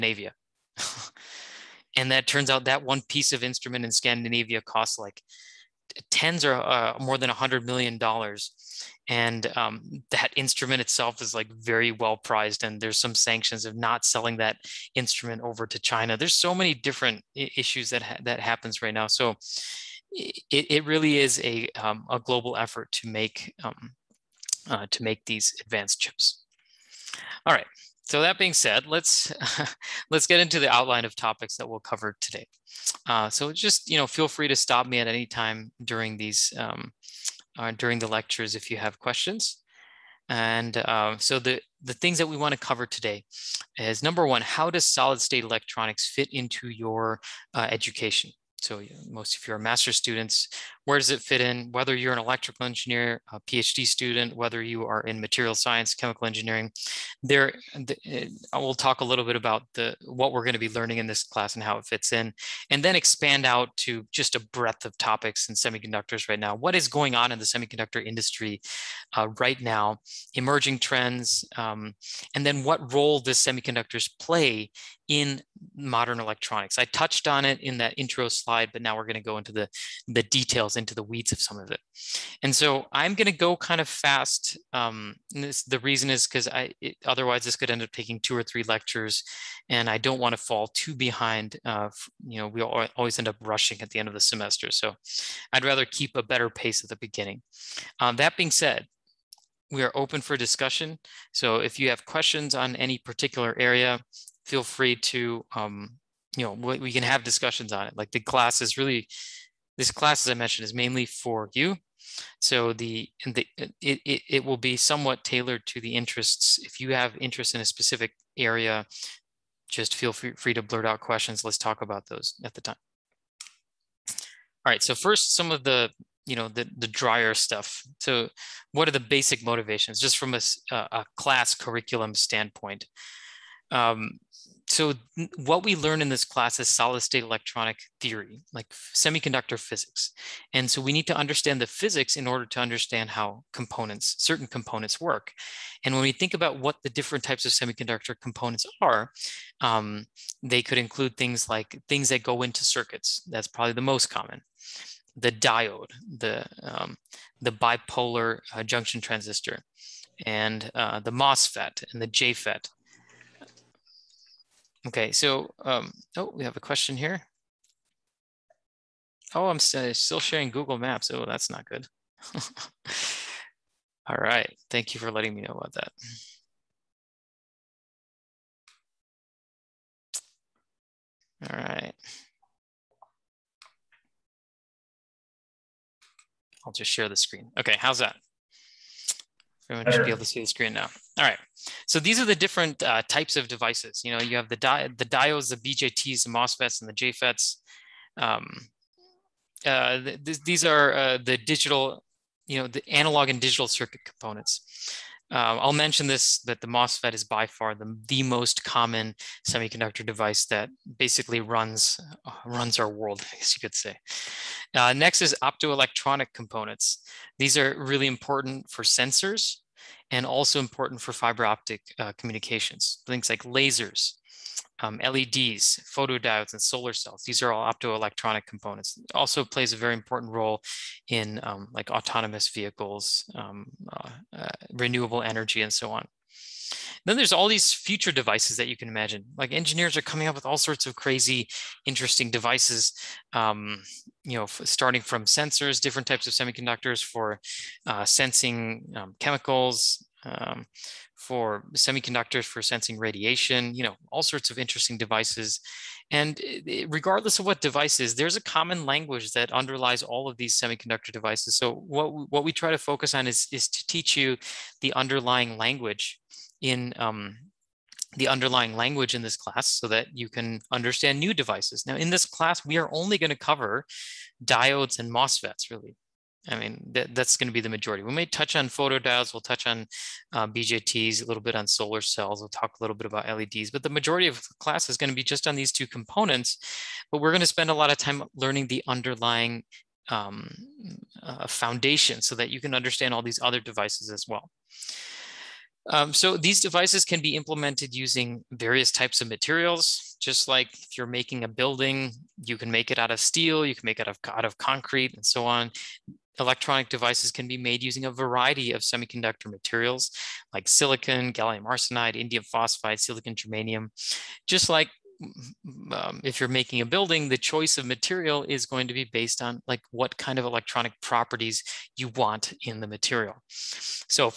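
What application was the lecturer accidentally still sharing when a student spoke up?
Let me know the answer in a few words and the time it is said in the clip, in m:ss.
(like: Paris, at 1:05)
Google Maps, at 2:50.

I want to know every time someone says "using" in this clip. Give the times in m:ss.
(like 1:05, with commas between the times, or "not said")
4:57, 5:07.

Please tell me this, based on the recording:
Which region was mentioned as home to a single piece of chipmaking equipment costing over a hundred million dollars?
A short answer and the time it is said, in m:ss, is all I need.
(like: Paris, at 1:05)
Scandinavia, at 0:03.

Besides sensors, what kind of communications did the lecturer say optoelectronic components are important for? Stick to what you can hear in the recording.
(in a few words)
fiber optic.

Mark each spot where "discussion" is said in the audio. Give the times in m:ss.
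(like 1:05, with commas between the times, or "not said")
1:40, 1:47.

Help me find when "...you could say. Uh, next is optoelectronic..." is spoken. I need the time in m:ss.
3:33.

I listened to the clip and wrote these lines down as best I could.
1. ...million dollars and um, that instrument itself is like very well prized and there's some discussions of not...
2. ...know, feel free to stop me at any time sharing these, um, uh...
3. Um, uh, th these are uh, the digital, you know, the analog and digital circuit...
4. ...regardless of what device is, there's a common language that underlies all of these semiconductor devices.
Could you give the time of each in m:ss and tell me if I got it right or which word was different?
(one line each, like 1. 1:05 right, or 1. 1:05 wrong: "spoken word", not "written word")
1. 0:07 wrong: "sanctions", not "discussions"
2. 0:33 wrong: "during", not "sharing"
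3. 3:18 right
4. 4:16 right.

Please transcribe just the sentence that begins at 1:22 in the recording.
And so I'm going to go kind of fast.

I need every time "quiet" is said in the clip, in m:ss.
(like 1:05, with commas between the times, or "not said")
not said.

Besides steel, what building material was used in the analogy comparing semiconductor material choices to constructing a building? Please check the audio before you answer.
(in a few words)
concrete.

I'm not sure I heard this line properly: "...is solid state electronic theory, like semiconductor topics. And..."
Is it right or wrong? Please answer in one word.
wrong.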